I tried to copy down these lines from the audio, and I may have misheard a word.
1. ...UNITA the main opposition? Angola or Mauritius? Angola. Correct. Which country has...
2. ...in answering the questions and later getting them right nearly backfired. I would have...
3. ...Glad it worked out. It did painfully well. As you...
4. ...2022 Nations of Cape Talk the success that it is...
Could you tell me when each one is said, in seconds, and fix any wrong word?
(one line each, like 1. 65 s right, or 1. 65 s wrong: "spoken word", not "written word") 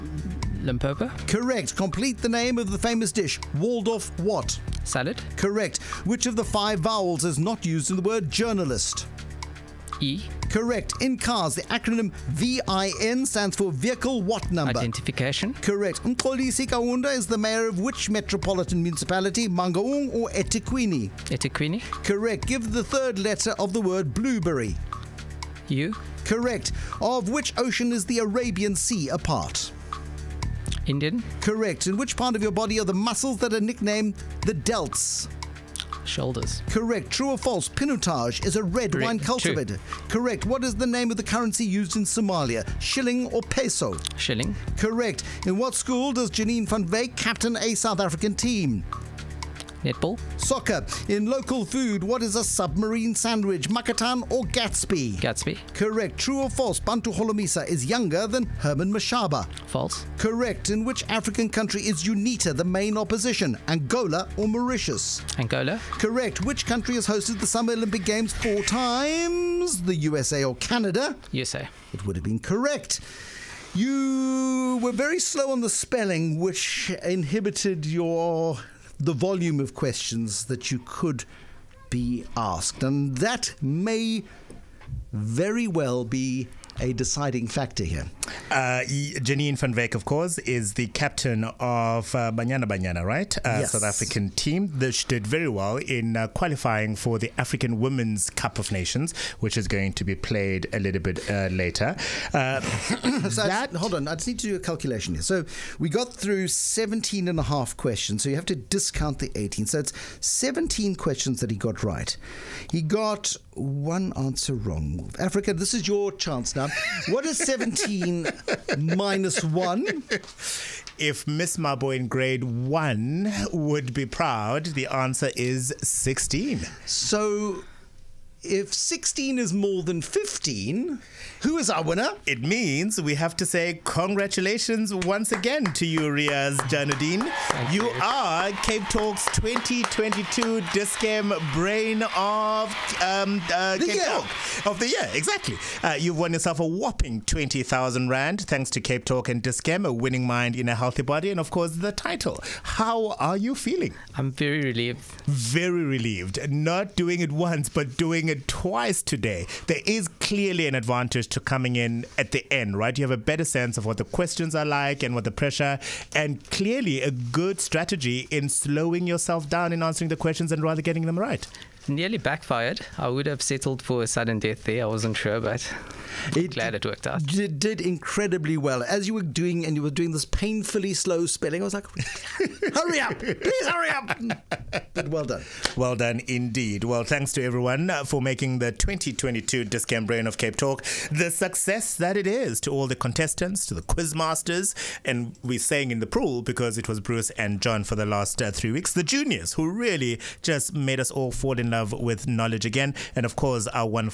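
1. 62 s right
2. 169 s wrong: "rather", not "later"
3. 176 s wrong: "incredibly", not "painfully"
4. 188 s wrong: "Brain", not "Nations".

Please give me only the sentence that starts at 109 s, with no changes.
So it's 17 questions that he got right.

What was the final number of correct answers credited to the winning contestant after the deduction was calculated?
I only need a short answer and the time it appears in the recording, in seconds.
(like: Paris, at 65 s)
16, at 124 s.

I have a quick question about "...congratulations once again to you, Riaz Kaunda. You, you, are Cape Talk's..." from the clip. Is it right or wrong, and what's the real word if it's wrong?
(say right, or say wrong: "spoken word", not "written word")
wrong: "Janadine", not "Kaunda".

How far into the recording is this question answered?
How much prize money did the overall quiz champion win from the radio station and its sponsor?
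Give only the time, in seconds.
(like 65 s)
147 s.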